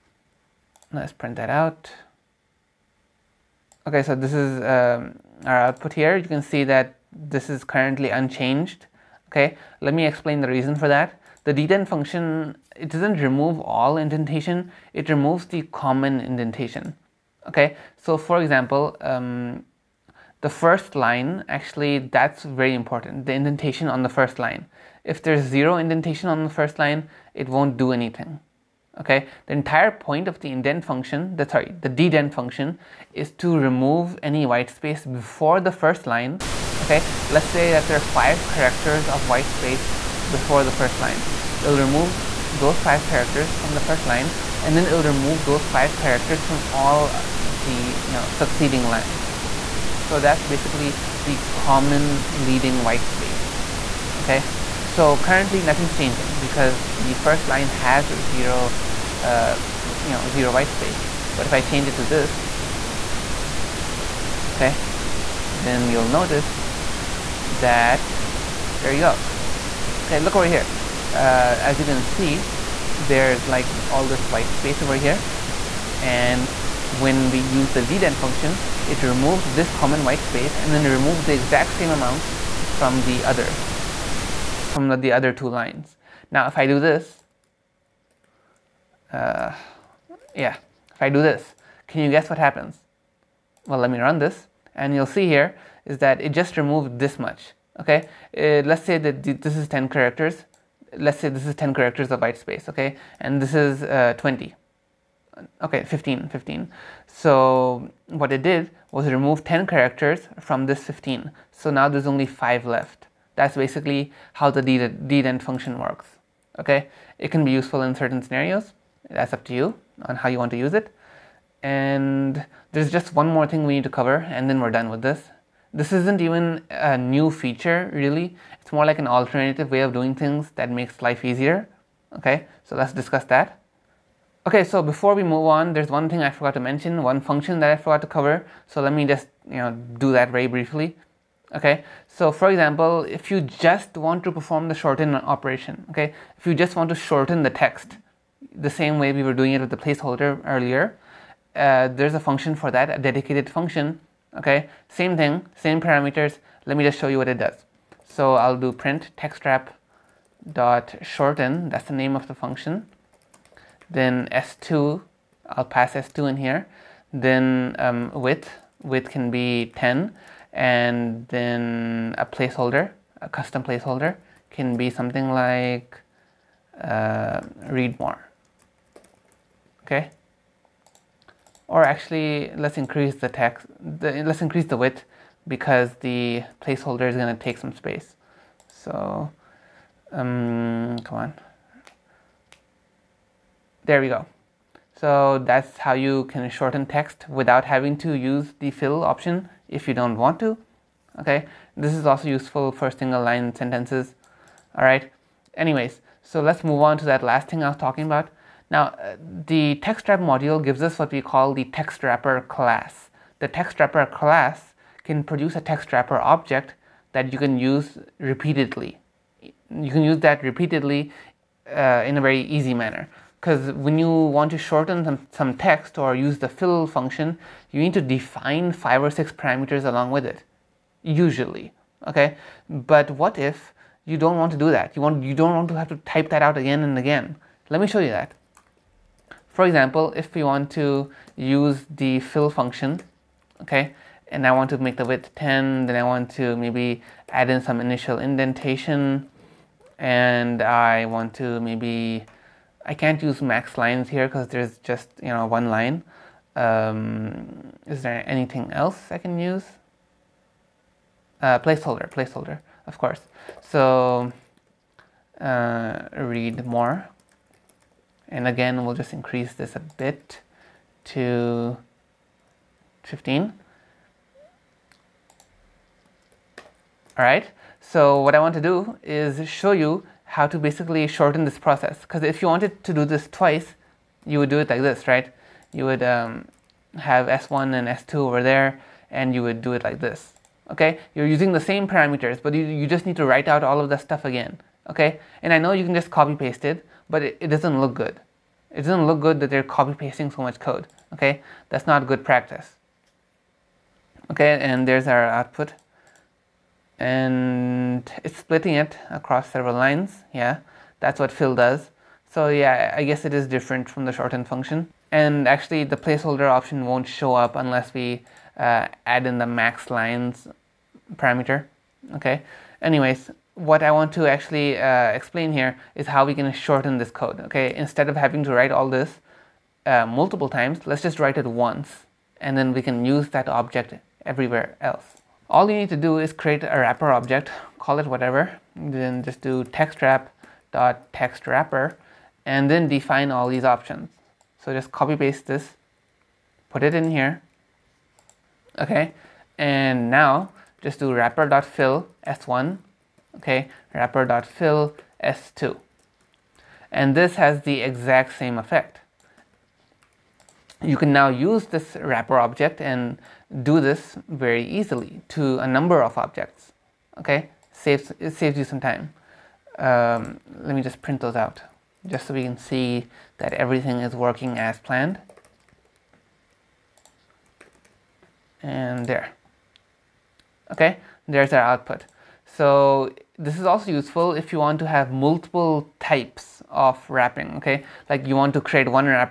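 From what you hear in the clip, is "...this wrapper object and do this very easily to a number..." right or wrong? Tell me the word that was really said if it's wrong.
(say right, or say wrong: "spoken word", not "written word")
right.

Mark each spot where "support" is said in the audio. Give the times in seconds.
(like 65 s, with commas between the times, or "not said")
not said.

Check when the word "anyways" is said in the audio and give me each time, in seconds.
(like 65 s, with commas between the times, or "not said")
205 s, 322 s.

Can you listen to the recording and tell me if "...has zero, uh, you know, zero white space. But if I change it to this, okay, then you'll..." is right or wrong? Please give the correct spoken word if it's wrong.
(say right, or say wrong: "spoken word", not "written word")
right.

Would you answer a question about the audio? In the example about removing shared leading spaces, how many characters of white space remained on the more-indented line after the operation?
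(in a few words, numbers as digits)
5.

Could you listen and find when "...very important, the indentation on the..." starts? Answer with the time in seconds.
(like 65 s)
22 s.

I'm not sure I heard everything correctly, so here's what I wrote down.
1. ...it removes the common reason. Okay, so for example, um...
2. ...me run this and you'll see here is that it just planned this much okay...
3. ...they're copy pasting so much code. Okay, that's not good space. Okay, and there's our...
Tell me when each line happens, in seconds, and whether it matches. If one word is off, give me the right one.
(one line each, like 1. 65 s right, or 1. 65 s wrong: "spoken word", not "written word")
1. 14 s wrong: "indentation", not "reason"
2. 93 s wrong: "removed", not "planned"
3. 299 s wrong: "practice", not "space".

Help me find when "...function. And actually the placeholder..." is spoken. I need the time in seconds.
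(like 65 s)
314 s.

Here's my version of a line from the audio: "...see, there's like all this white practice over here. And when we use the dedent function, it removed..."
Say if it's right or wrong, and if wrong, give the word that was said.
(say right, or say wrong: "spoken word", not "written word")
wrong: "space", not "practice".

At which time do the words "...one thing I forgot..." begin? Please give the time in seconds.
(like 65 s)
135 s.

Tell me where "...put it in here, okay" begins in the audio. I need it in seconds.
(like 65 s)
346 s.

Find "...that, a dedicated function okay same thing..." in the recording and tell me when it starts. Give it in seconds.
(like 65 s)
152 s.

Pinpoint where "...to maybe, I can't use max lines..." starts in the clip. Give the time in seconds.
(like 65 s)
251 s.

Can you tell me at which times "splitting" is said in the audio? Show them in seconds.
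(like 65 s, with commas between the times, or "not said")
308 s.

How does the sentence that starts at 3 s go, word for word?
Okay, so this is um, our output here.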